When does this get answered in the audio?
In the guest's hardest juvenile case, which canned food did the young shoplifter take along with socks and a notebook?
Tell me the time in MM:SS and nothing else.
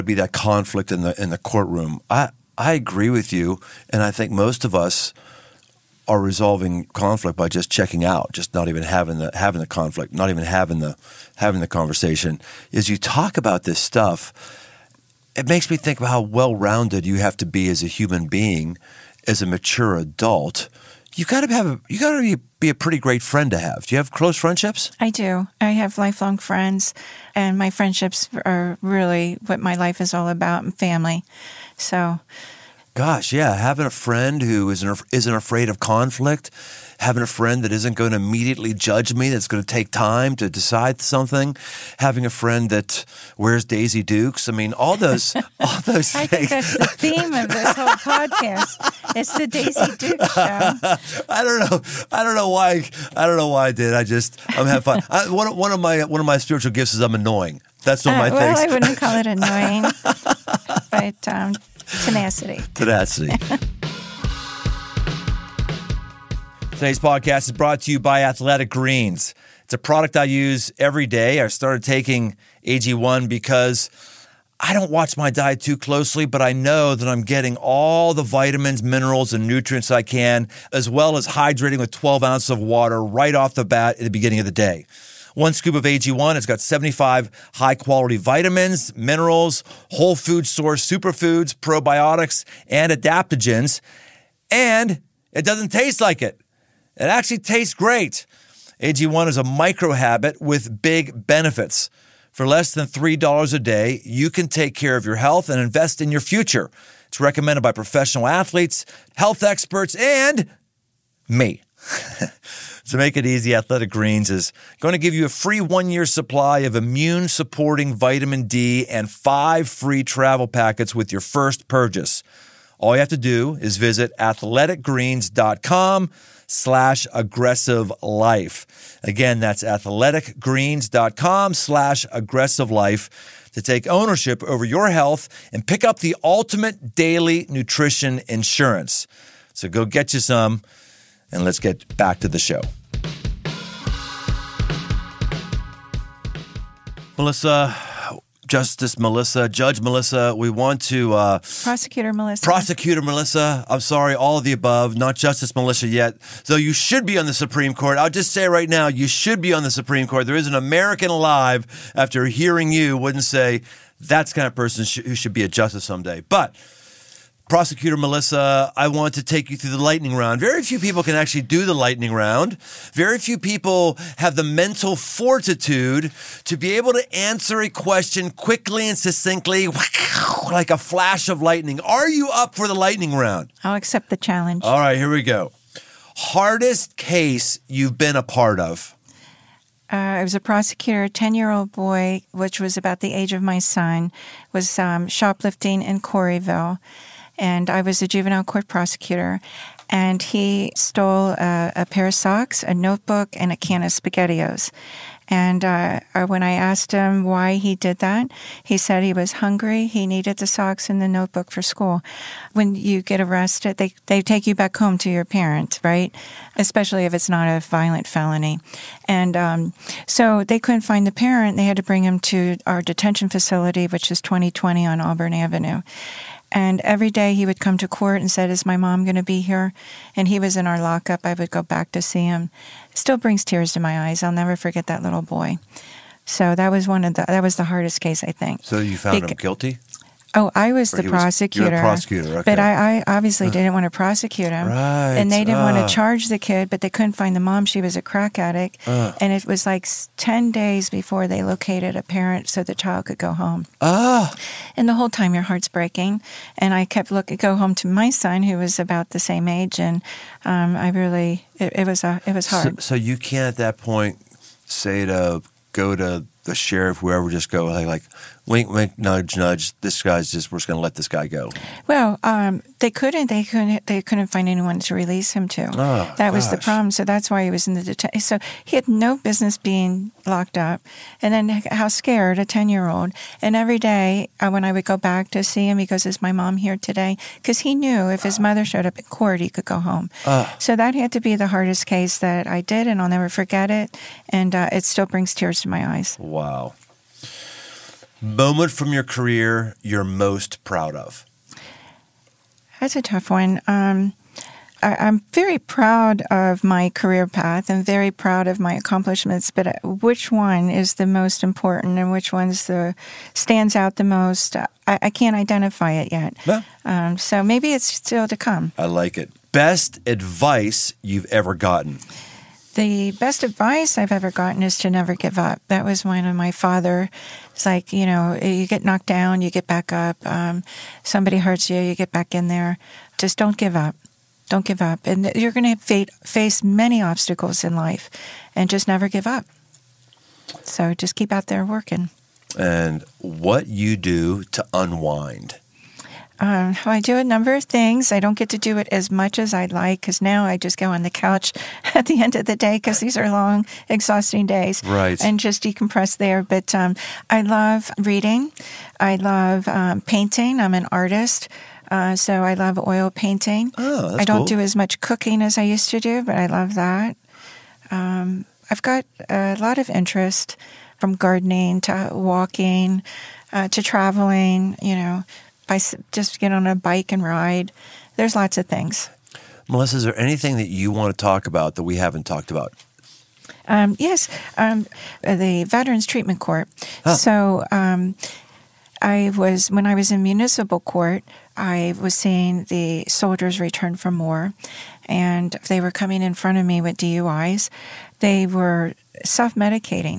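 03:23.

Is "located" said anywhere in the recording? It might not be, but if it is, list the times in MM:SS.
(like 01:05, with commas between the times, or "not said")
04:11.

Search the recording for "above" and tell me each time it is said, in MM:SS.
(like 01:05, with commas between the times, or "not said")
02:34.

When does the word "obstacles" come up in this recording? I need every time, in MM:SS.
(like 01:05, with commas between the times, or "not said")
05:37.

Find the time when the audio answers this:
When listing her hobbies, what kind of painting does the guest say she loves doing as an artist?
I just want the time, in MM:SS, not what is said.
06:02.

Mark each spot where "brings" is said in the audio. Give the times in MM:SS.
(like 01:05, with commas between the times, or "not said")
03:41, 03:53, 04:55.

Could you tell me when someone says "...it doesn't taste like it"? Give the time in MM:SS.
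01:35.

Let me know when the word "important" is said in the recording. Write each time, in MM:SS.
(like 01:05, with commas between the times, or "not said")
05:11.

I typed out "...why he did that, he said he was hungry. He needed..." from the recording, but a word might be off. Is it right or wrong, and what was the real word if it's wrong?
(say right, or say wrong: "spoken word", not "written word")
right.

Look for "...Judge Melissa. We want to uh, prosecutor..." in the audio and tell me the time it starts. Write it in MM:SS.
02:29.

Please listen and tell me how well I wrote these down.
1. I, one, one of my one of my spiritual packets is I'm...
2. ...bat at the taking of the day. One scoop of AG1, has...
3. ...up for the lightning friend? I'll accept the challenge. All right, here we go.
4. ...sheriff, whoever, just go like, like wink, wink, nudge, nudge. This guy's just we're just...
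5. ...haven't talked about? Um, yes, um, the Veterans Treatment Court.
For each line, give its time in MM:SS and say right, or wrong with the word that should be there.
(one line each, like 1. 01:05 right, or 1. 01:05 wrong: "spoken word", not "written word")
1. 00:55 wrong: "gifts", not "packets"
2. 01:23 wrong: "beginning", not "taking"
3. 03:02 wrong: "round", not "friend"
4. 04:26 right
5. 06:21 right.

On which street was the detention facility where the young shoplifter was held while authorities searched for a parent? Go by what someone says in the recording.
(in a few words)
Auburn Avenue.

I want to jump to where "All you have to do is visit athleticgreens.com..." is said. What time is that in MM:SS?
02:02.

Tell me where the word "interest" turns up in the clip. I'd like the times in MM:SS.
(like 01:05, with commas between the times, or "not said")
06:09.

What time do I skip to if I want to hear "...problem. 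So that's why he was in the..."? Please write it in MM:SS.
04:36.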